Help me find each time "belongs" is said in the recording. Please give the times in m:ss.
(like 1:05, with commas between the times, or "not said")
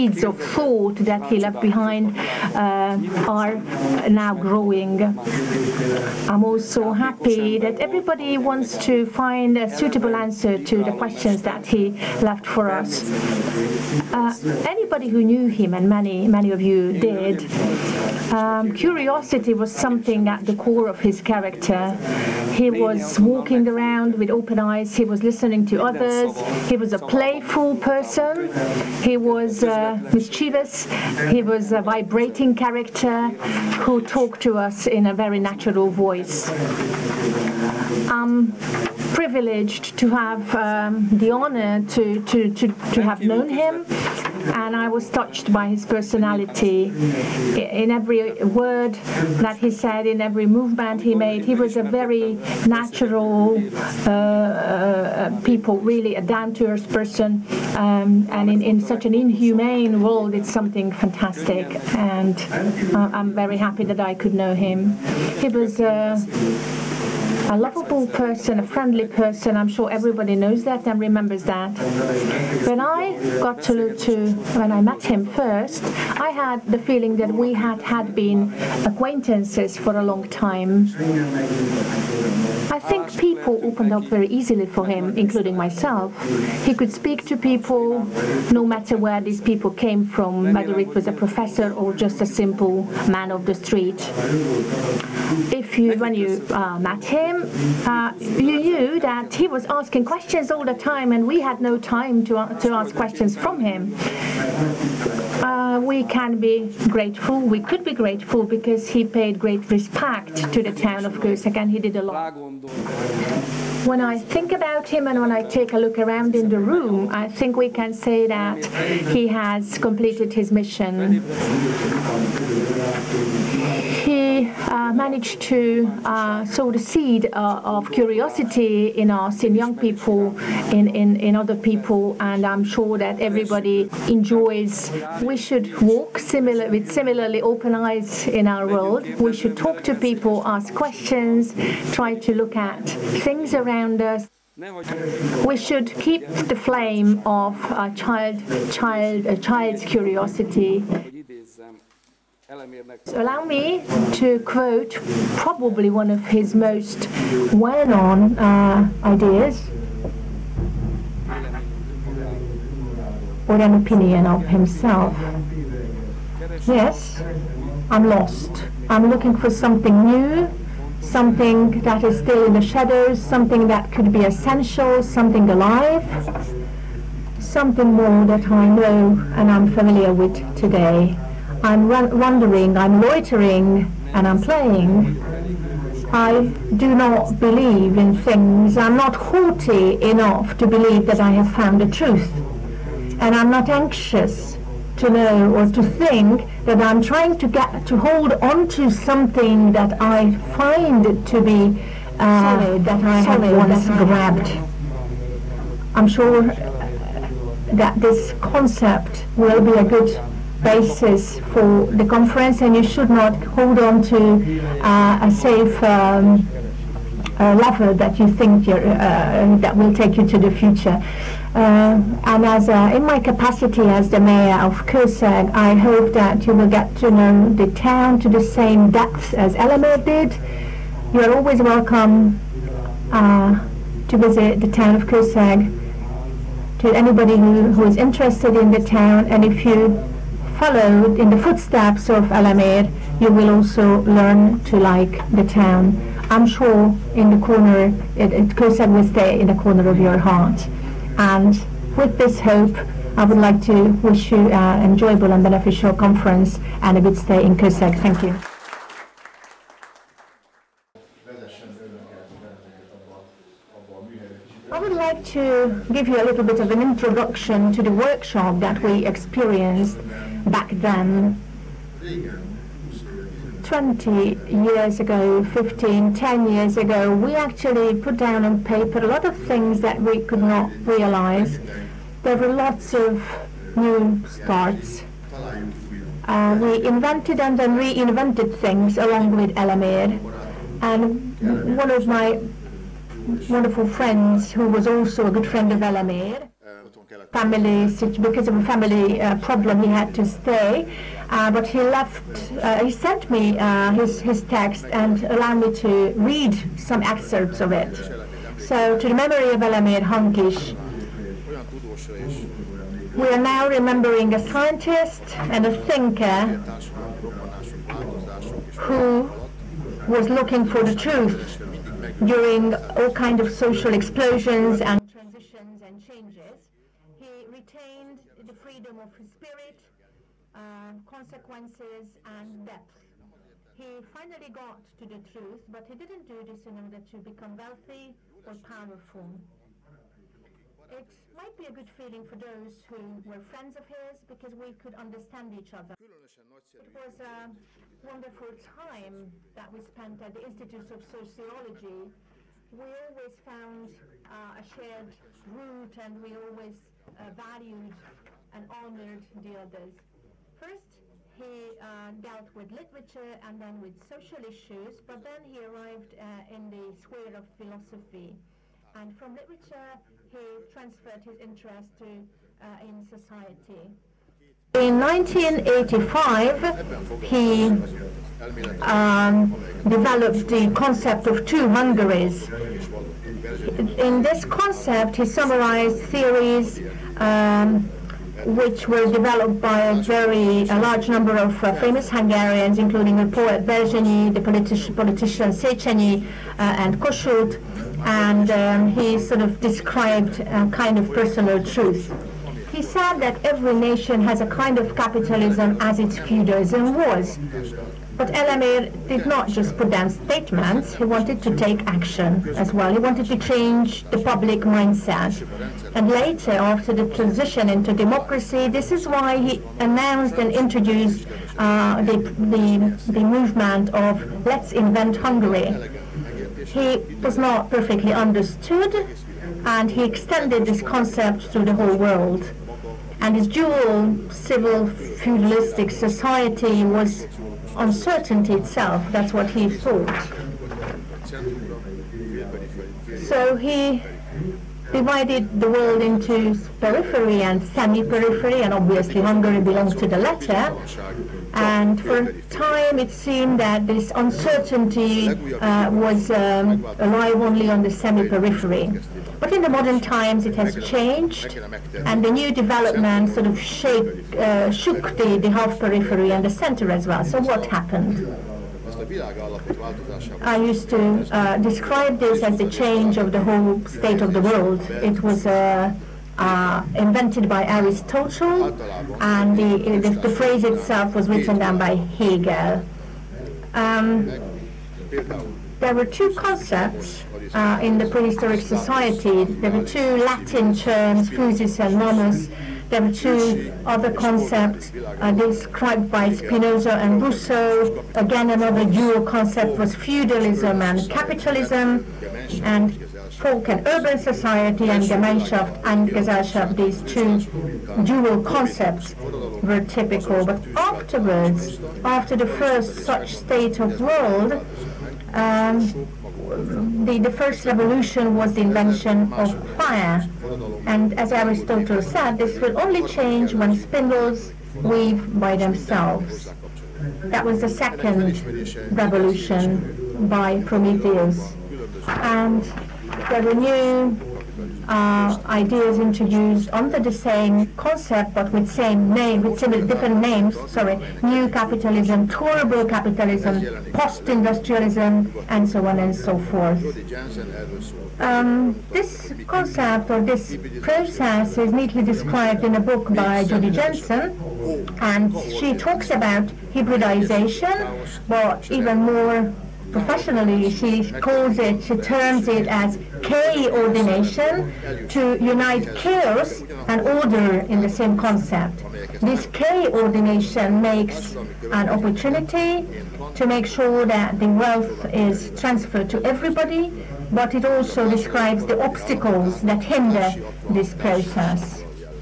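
7:29.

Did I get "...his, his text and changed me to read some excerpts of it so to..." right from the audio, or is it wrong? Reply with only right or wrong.
wrong.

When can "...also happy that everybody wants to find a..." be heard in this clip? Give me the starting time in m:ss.
0:06.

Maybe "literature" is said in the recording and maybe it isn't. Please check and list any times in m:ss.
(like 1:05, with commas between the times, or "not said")
6:02, 6:09.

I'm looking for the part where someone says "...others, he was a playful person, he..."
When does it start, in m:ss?
0:25.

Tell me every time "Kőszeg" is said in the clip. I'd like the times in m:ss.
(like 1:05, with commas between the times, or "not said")
1:51, 3:44, 3:55, 4:17.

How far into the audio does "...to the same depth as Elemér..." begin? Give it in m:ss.
3:48.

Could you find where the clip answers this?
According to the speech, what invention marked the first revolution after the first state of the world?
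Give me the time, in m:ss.
8:38.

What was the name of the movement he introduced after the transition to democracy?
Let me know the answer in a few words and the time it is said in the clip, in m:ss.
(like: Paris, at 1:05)
Let's Invent Hungary, at 7:04.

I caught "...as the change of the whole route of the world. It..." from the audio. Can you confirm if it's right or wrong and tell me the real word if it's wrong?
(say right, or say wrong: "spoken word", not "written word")
wrong: "state", not "route".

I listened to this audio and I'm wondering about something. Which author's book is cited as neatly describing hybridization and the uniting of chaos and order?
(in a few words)
Judy Jensen.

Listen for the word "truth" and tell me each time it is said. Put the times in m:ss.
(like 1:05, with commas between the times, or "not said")
3:11, 5:20, 5:35, 6:41.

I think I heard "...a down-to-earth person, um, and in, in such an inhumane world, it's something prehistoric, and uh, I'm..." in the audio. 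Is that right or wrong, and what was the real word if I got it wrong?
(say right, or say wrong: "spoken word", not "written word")
wrong: "fantastic", not "prehistoric".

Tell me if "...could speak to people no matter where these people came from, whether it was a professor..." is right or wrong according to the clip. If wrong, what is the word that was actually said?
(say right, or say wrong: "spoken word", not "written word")
right.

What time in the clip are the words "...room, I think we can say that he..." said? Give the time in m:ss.
1:56.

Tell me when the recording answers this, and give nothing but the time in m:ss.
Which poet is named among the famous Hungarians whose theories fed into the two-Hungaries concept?
6:33.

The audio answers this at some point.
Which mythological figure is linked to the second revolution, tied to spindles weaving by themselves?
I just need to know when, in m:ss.
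8:50.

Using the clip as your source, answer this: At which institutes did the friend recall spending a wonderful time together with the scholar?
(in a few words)
Institutes of Sociology.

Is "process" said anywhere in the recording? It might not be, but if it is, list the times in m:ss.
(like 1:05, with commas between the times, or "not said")
9:10, 9:40.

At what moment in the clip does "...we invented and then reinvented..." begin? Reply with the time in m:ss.
4:46.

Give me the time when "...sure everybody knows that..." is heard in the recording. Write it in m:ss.
1:09.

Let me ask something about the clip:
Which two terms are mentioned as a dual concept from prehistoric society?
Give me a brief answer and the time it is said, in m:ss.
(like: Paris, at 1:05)
physis and nomos, at 8:11.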